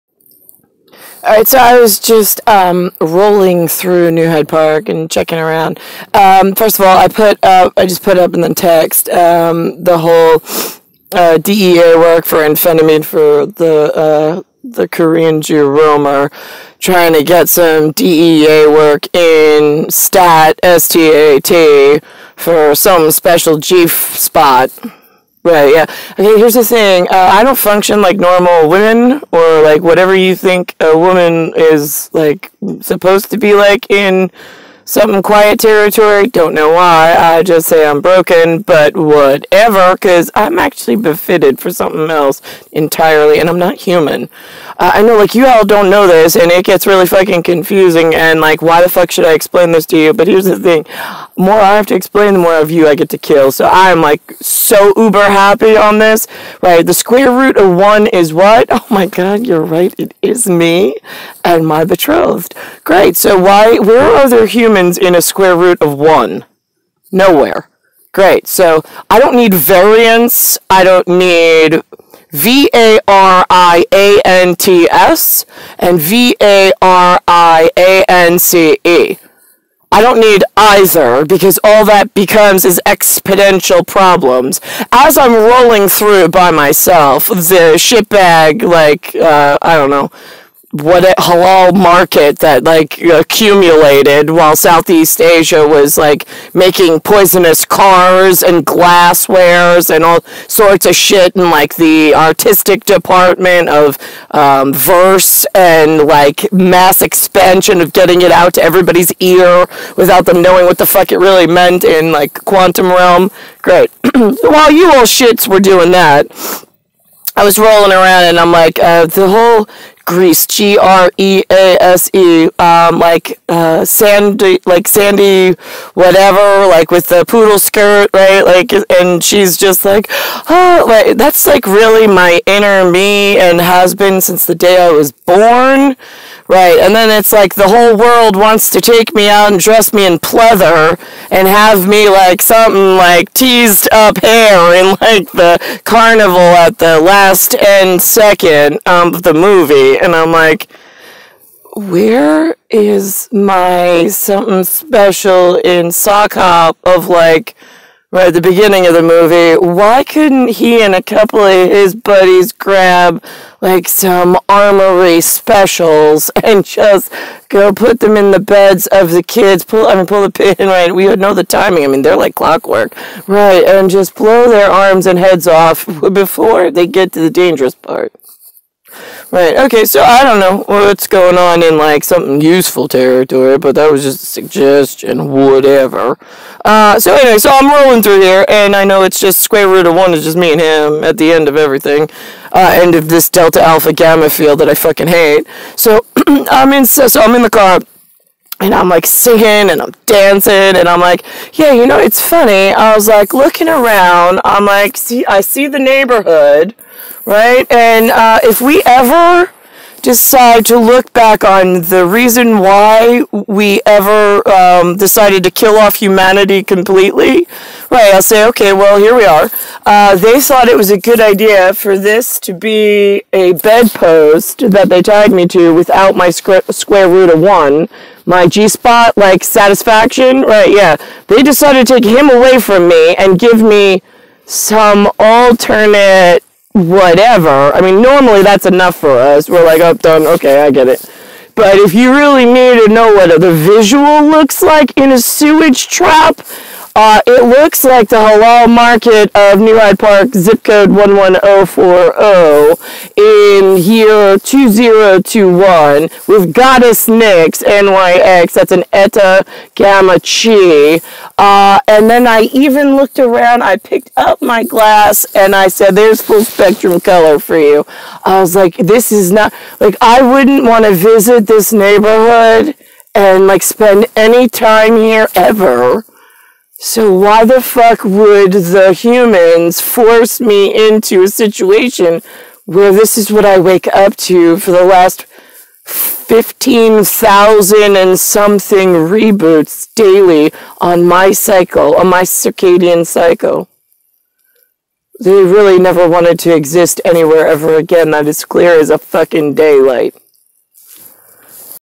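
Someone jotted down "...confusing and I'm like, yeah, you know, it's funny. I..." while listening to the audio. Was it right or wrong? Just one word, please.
wrong.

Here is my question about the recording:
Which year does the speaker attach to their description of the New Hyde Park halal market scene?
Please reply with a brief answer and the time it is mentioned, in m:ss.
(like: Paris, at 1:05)
2021, at 4:14.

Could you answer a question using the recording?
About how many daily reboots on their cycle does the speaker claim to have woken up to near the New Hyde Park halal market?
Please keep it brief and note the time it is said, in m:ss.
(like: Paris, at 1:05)
15,000, at 4:45.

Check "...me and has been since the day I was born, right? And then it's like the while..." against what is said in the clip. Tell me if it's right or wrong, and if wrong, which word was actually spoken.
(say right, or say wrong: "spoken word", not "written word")
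wrong: "whole", not "while".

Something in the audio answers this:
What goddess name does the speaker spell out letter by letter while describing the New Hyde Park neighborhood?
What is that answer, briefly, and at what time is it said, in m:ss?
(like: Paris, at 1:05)
Nyx, at 4:17.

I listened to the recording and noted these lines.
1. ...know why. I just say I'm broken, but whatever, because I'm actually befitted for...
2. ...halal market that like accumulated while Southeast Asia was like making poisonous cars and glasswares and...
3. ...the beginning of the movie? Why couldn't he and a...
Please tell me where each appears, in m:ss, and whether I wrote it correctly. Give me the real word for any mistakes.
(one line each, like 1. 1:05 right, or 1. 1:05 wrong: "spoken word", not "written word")
1. 0:36 right
2. 1:31 right
3. 2:38 right.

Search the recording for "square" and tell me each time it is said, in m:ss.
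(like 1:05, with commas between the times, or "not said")
0:56, 1:05, 3:09, 3:46.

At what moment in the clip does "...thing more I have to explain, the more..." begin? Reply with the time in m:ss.
0:50.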